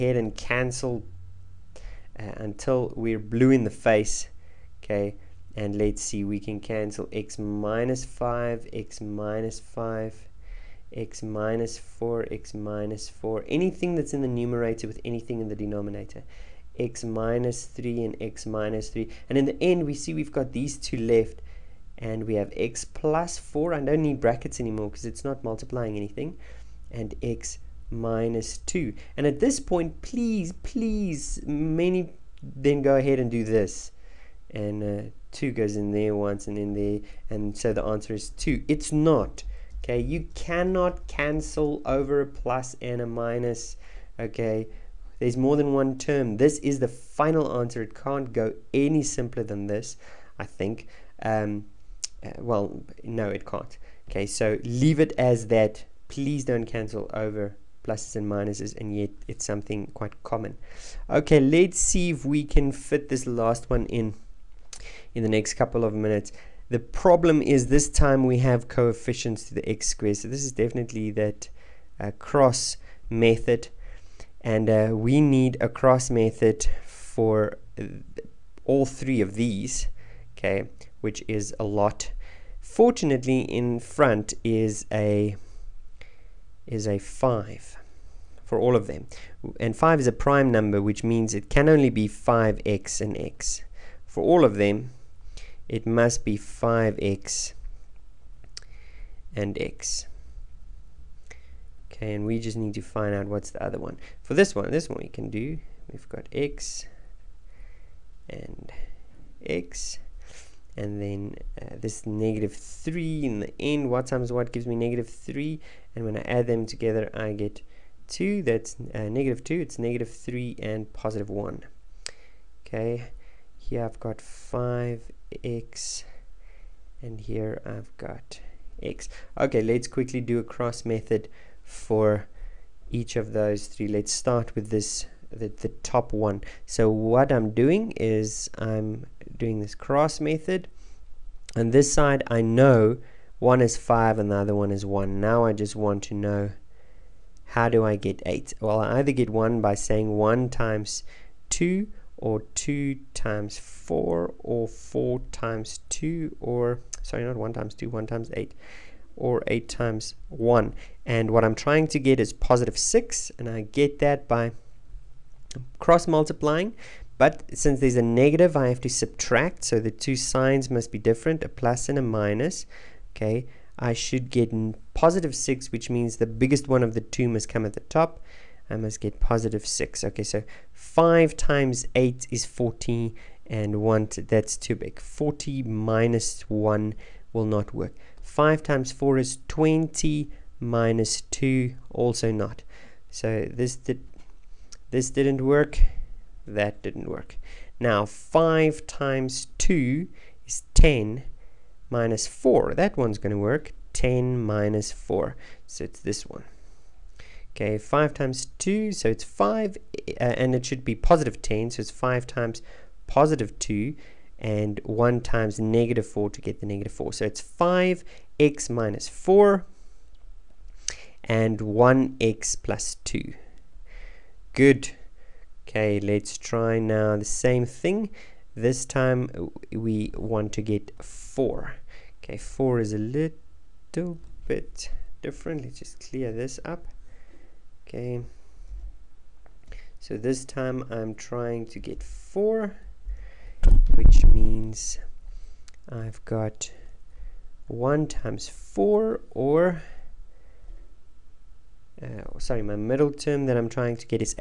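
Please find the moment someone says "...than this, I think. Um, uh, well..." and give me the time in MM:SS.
00:49.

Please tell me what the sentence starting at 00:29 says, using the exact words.
And at this point, please, please, many then go ahead and do this.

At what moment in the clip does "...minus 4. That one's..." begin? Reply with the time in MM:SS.
03:21.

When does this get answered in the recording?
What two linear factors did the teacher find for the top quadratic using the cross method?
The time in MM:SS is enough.
03:37.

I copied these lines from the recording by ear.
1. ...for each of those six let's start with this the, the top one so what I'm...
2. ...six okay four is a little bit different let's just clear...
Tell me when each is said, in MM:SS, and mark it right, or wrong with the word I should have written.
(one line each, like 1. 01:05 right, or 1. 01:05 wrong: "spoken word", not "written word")
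1. 02:11 wrong: "three", not "six"
2. 03:51 wrong: "four", not "six".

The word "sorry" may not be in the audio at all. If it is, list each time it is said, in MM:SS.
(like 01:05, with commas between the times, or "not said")
02:37, 04:12.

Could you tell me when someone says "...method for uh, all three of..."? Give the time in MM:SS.
01:16.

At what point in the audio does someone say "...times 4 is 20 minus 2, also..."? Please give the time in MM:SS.
03:08.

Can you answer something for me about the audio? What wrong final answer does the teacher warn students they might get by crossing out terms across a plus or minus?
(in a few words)
2.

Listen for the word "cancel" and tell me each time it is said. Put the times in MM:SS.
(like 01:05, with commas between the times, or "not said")
00:00, 00:06, 00:41, 00:56.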